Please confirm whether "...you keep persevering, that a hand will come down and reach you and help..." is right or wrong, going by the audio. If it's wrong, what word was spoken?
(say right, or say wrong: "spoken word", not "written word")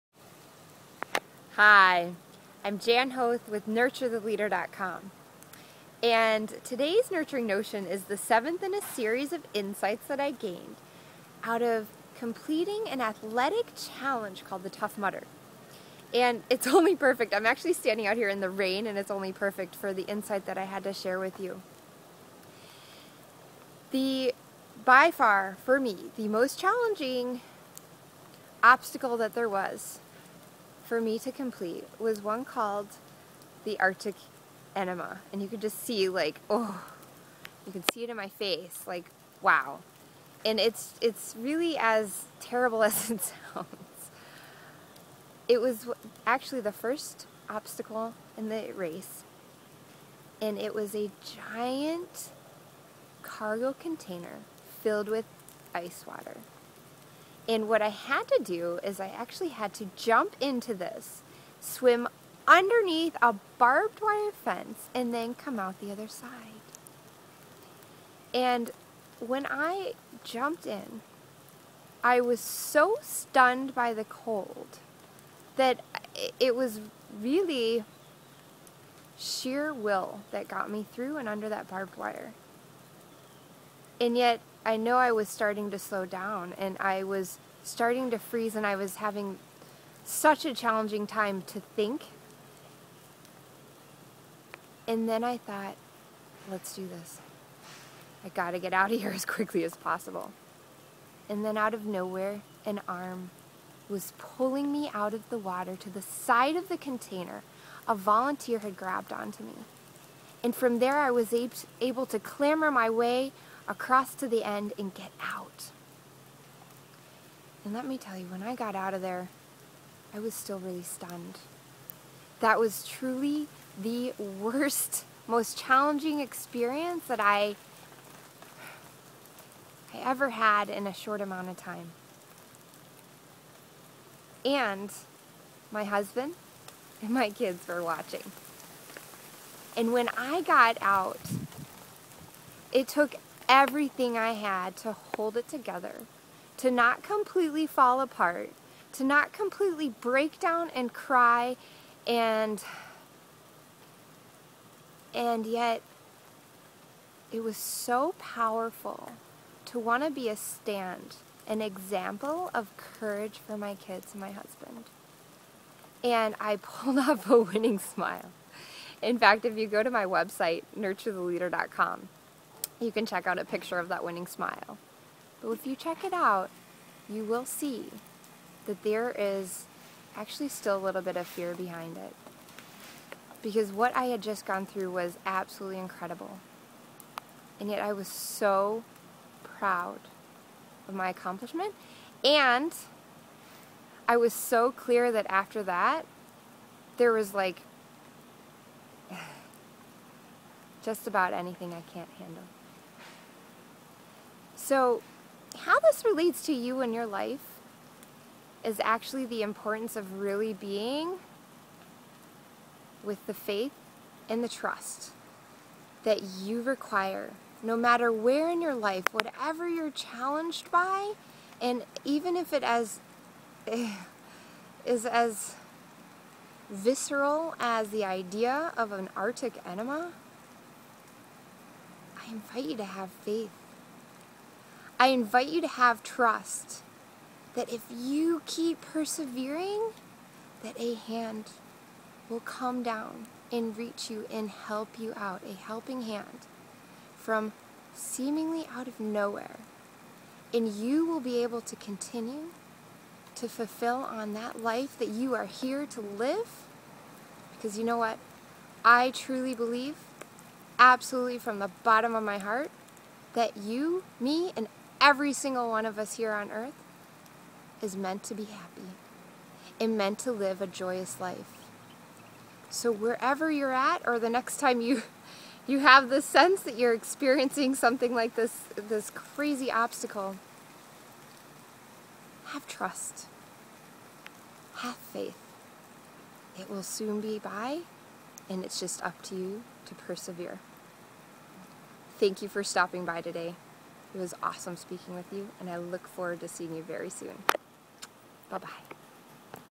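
right.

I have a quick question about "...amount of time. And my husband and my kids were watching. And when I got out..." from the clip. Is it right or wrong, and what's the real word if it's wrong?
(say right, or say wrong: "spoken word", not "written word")
right.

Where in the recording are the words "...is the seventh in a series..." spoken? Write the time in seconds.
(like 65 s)
7 s.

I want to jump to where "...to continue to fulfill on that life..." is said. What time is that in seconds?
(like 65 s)
251 s.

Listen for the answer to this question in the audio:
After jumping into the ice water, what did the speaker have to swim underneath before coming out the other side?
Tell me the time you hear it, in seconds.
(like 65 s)
63 s.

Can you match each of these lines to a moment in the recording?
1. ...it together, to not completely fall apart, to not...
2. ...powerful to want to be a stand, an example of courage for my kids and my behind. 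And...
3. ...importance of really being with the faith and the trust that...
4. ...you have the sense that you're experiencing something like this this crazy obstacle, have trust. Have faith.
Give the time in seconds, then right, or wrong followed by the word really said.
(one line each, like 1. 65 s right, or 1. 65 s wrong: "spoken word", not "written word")
1. 145 s right
2. 158 s wrong: "husband", not "behind"
3. 209 s right
4. 275 s right.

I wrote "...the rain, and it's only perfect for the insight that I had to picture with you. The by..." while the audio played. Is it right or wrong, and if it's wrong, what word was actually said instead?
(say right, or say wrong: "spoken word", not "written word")
wrong: "share", not "picture".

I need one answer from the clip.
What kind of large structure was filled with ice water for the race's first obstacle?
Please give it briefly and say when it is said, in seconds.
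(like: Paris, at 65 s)
Cargo container, at 53 s.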